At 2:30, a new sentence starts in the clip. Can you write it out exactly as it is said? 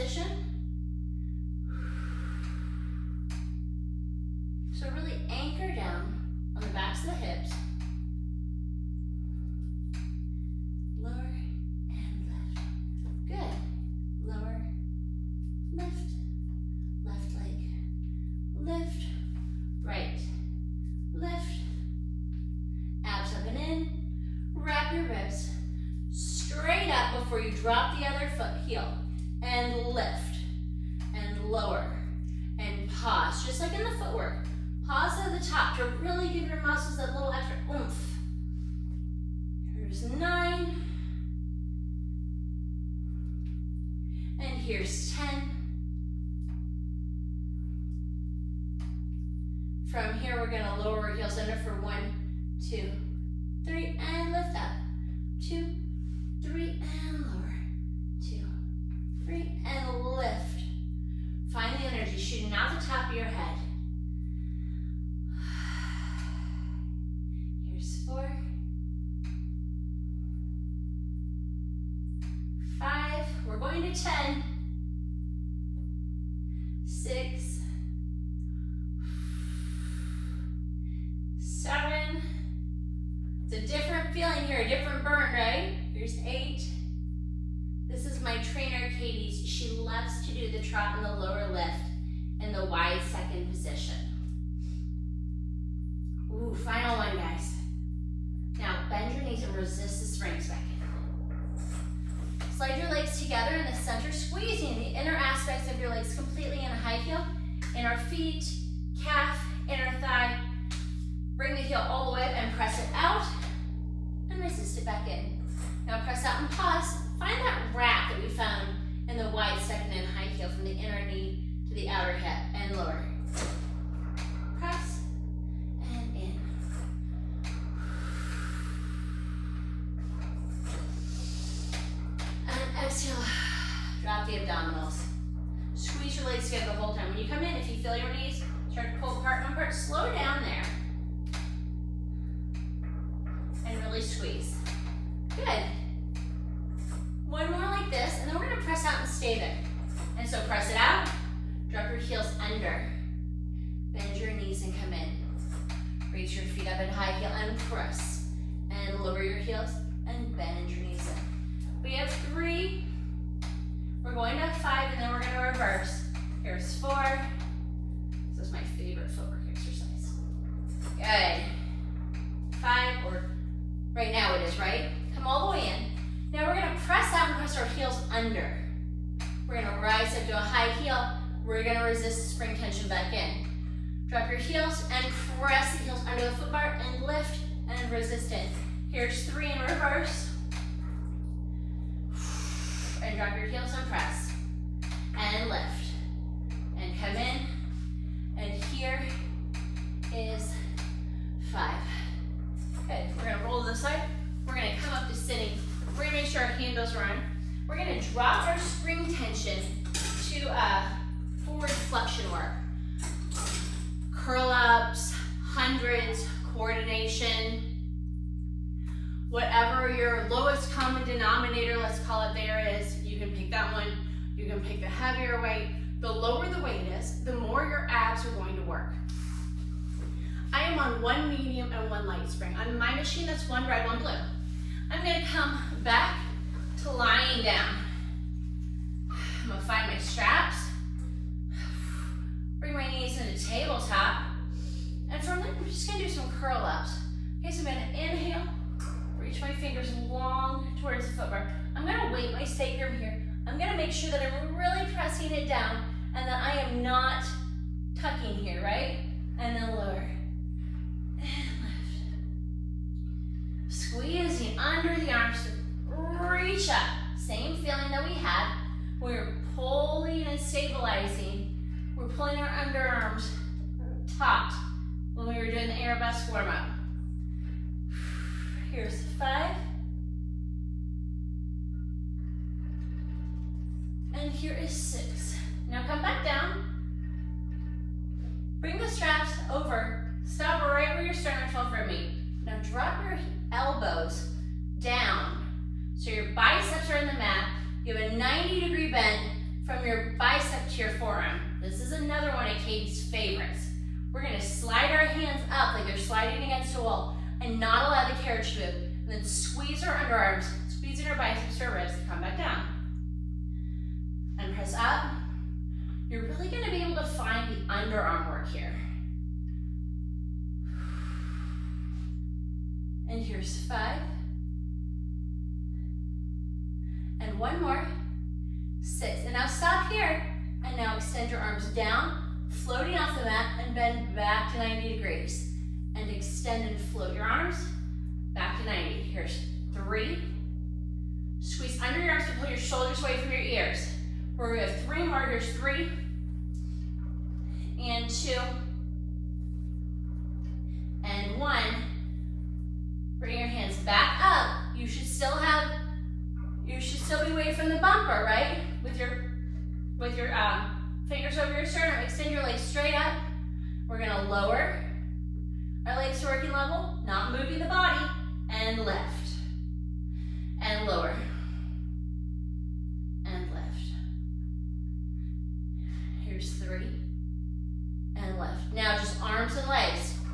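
And so press it out, drop your heels under, bend your knees and come in.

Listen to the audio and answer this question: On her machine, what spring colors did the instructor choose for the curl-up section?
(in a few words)
One red, one blue.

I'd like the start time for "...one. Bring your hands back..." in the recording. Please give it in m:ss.
5:51.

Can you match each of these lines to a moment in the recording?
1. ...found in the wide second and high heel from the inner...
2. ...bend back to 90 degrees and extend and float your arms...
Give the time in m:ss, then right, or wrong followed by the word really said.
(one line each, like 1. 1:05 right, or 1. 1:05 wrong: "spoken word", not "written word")
1. 1:58 right
2. 5:33 right.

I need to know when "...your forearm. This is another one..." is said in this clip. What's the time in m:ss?
5:00.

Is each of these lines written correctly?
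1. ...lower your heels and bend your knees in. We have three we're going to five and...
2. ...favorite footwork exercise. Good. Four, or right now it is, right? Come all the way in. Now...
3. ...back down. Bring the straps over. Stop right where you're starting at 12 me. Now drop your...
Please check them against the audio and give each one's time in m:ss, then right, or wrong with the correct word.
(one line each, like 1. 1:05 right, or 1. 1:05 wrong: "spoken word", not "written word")
1. 2:39 right
2. 2:48 wrong: "Five", not "Four"
3. 4:46 right.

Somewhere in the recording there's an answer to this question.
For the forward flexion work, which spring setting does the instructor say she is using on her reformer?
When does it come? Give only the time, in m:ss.
3:51.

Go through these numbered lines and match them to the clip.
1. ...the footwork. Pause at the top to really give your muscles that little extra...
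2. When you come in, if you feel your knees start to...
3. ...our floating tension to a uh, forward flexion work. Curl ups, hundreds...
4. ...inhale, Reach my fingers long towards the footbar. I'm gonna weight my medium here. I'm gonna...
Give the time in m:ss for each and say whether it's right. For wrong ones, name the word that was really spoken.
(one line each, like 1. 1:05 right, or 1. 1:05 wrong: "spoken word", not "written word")
1. 0:33 right
2. 2:17 right
3. 3:28 wrong: "spring", not "floating"
4. 4:07 wrong: "sacrum", not "medium".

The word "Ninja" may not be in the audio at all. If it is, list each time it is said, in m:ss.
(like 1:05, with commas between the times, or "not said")
not said.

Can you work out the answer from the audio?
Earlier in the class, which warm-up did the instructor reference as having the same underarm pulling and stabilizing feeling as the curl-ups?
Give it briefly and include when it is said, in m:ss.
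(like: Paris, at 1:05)
Arabesque warm-up, at 4:35.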